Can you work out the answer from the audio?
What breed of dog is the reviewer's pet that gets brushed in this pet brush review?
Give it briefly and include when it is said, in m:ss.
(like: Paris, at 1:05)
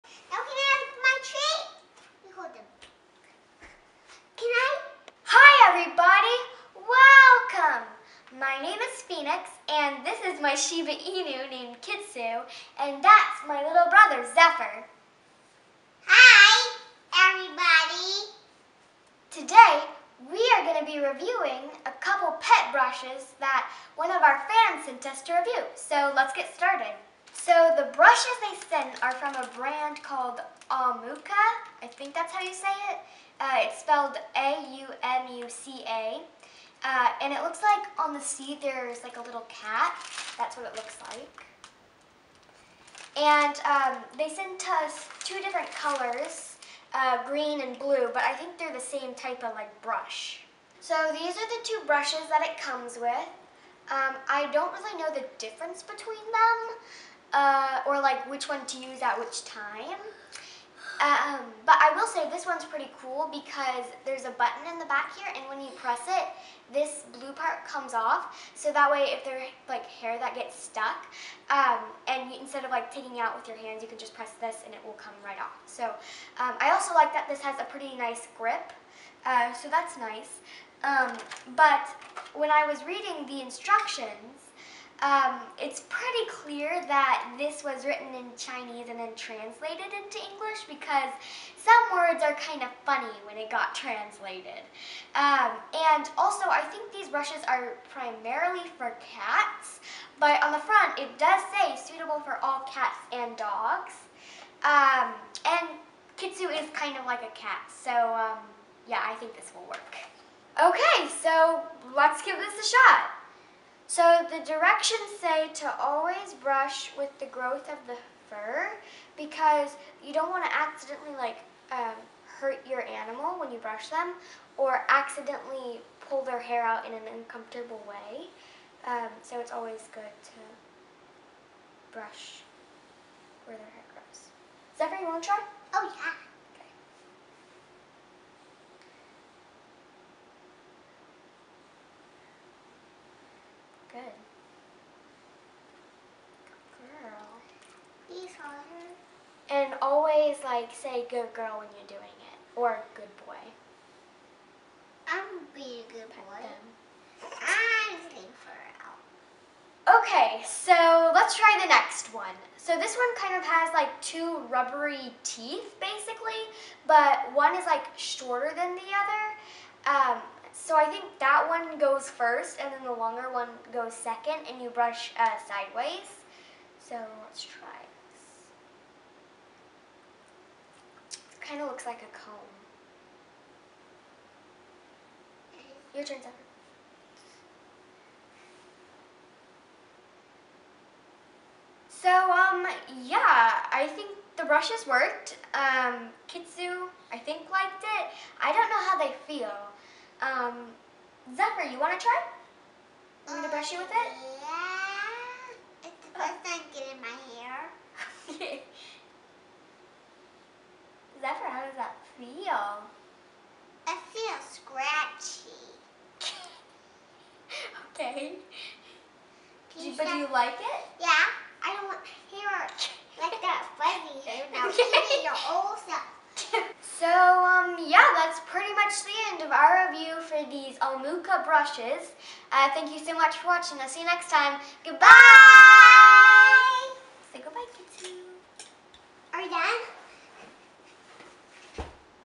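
Shiba Inu, at 0:10.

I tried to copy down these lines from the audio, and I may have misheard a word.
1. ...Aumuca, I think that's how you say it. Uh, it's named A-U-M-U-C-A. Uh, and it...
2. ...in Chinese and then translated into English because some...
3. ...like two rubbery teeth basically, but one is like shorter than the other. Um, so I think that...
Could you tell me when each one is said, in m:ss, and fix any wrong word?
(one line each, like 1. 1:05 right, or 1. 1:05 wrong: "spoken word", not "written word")
1. 0:30 wrong: "spelled", not "named"
2. 1:28 right
3. 2:43 right.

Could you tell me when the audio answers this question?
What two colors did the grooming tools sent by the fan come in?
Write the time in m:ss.
0:47.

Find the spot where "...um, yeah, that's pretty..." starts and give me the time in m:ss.
3:47.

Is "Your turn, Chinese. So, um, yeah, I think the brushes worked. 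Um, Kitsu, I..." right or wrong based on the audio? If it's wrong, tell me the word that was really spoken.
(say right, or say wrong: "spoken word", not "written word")
wrong: "Zephyr", not "Chinese".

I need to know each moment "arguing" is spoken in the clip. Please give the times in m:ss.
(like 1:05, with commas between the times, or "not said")
not said.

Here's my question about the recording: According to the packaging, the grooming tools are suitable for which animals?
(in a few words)
All cats and dogs.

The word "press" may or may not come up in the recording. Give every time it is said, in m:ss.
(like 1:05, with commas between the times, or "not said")
1:05, 1:14.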